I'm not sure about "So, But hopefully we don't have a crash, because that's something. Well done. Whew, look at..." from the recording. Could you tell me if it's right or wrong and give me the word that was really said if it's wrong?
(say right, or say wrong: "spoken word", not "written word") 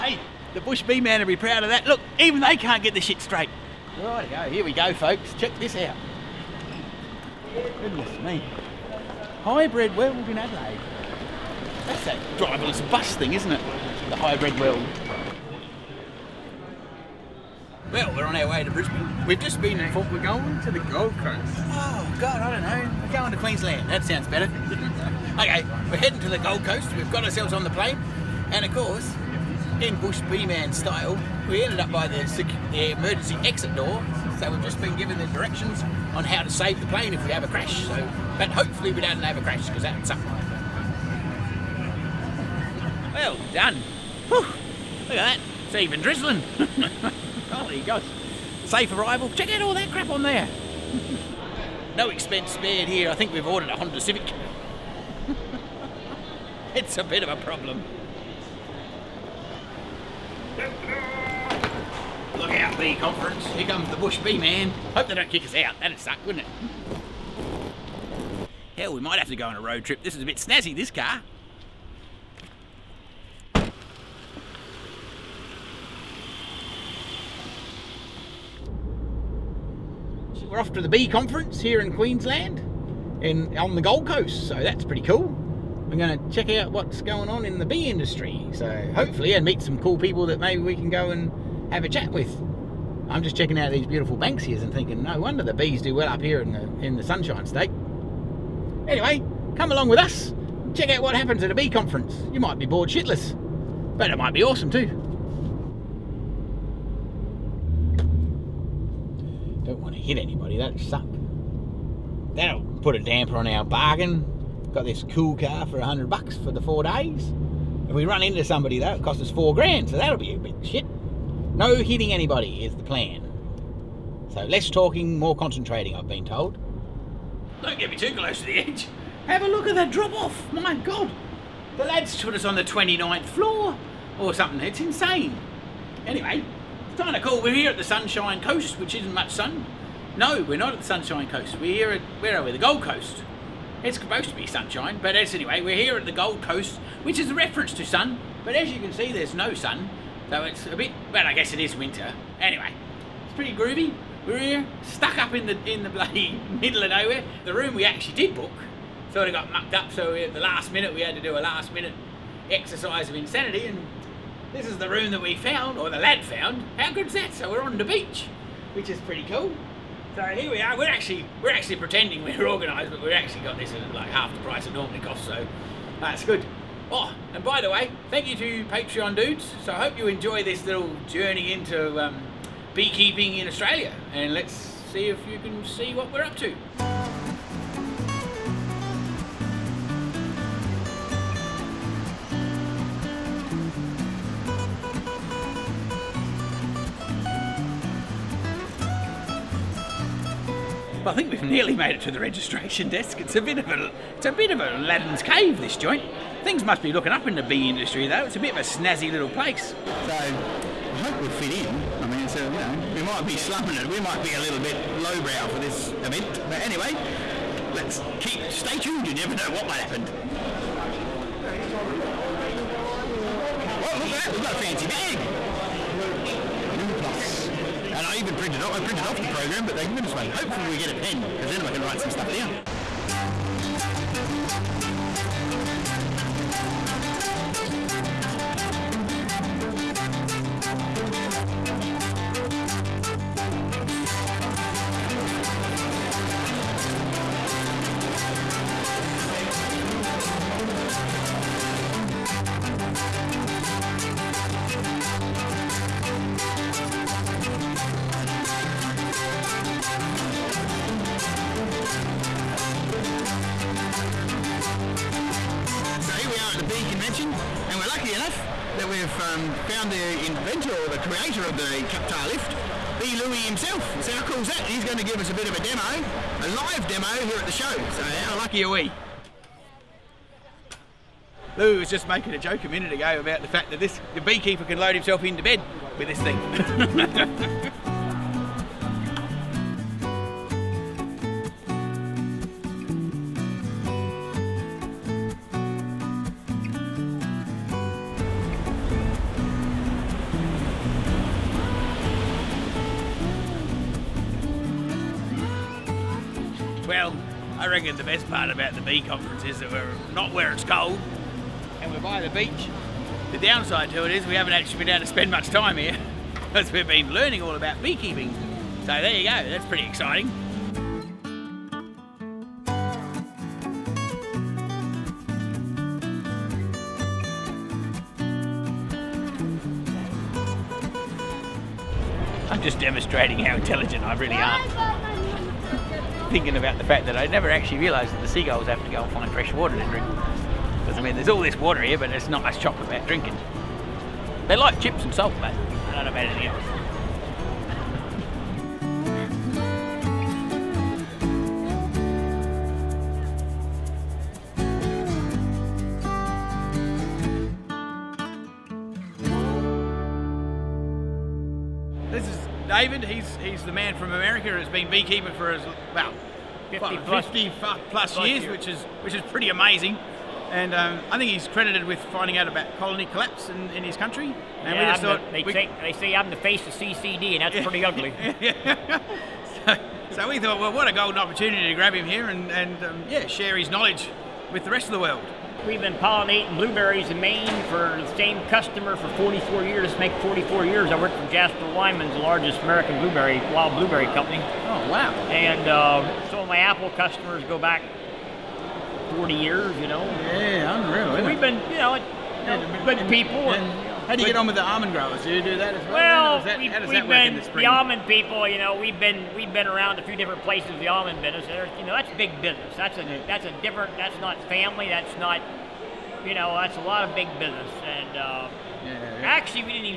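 right.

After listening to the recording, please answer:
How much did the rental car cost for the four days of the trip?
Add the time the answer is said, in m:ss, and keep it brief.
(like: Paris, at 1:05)
$100, at 1:55.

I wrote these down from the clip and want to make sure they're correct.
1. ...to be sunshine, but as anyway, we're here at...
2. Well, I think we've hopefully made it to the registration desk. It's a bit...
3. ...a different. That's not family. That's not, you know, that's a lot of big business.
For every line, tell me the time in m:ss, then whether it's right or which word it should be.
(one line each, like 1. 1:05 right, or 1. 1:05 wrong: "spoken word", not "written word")
1. 2:24 right
2. 3:21 wrong: "nearly", not "hopefully"
3. 6:53 right.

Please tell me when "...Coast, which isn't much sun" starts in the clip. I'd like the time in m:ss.
2:18.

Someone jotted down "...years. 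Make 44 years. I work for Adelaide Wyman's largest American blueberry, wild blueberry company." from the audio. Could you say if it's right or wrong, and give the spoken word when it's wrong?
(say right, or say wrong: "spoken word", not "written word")
wrong: "Jasper", not "Adelaide".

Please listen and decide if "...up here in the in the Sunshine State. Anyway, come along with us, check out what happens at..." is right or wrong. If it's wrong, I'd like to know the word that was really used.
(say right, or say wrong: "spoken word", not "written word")
right.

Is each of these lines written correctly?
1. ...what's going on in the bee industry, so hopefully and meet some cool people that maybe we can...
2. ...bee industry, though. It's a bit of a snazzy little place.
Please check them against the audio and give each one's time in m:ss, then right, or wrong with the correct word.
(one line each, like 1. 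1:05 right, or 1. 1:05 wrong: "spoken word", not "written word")
1. 1:26 right
2. 3:27 right.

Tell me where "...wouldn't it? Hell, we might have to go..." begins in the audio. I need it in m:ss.
1:06.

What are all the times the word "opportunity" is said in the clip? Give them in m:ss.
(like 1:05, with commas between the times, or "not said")
6:21.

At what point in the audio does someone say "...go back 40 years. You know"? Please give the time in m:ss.
6:37.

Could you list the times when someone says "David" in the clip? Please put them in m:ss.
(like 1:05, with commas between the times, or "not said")
6:02.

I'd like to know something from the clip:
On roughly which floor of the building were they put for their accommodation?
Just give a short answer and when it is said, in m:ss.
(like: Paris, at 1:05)
29th floor, at 2:12.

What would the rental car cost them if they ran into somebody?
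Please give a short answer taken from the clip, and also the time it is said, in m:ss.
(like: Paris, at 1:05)
4 grand, at 1:59.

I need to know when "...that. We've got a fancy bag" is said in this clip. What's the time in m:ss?
3:44.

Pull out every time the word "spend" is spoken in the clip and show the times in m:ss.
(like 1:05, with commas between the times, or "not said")
5:15.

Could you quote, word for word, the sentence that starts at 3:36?
But anyway, let's keep, stay tuned.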